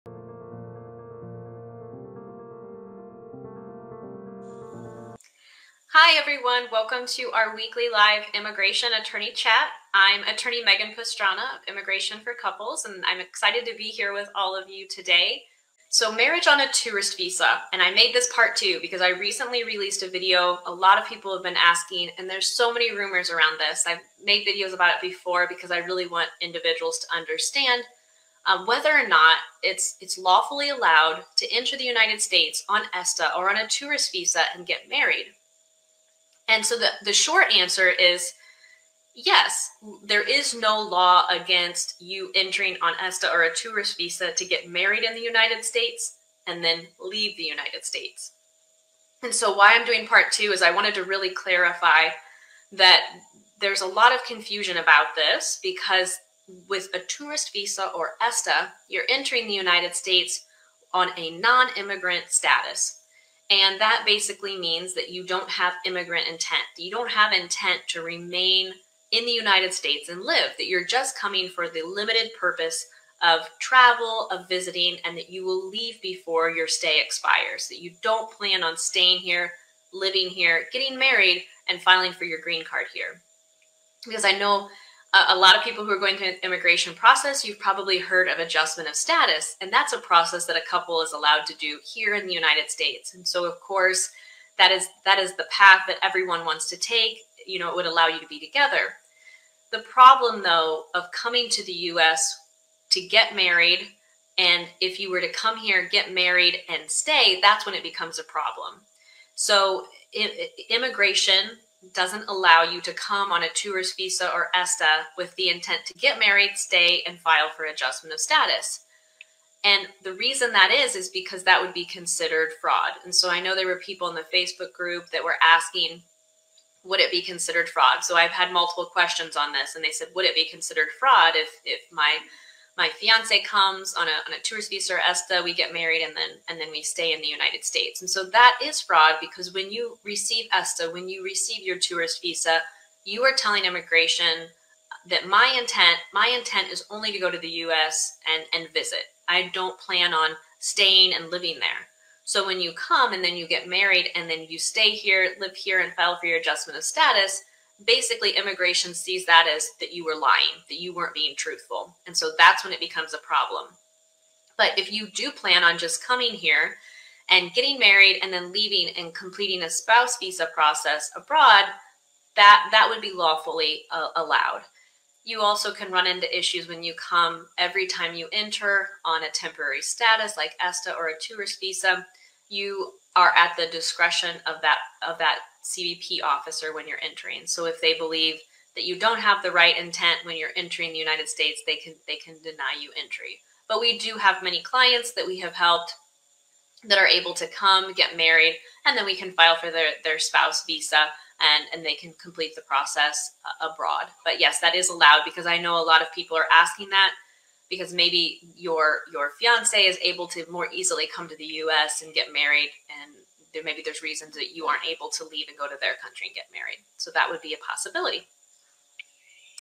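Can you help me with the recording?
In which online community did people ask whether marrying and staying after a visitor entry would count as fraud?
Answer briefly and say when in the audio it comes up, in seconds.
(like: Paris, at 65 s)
Facebook group, at 124 s.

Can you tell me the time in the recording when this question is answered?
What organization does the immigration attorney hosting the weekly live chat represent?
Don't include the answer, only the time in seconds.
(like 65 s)
11 s.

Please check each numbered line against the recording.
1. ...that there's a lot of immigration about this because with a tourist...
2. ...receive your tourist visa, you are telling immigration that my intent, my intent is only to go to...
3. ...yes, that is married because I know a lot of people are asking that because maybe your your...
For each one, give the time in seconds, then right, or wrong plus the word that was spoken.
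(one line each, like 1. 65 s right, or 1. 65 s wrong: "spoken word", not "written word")
1. 52 s wrong: "confusion", not "immigration"
2. 141 s right
3. 204 s wrong: "allowed", not "married".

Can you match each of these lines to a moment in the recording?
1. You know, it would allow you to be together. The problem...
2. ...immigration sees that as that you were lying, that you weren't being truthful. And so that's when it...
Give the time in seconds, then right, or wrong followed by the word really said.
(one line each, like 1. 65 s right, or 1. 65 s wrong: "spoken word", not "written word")
1. 97 s right
2. 158 s right.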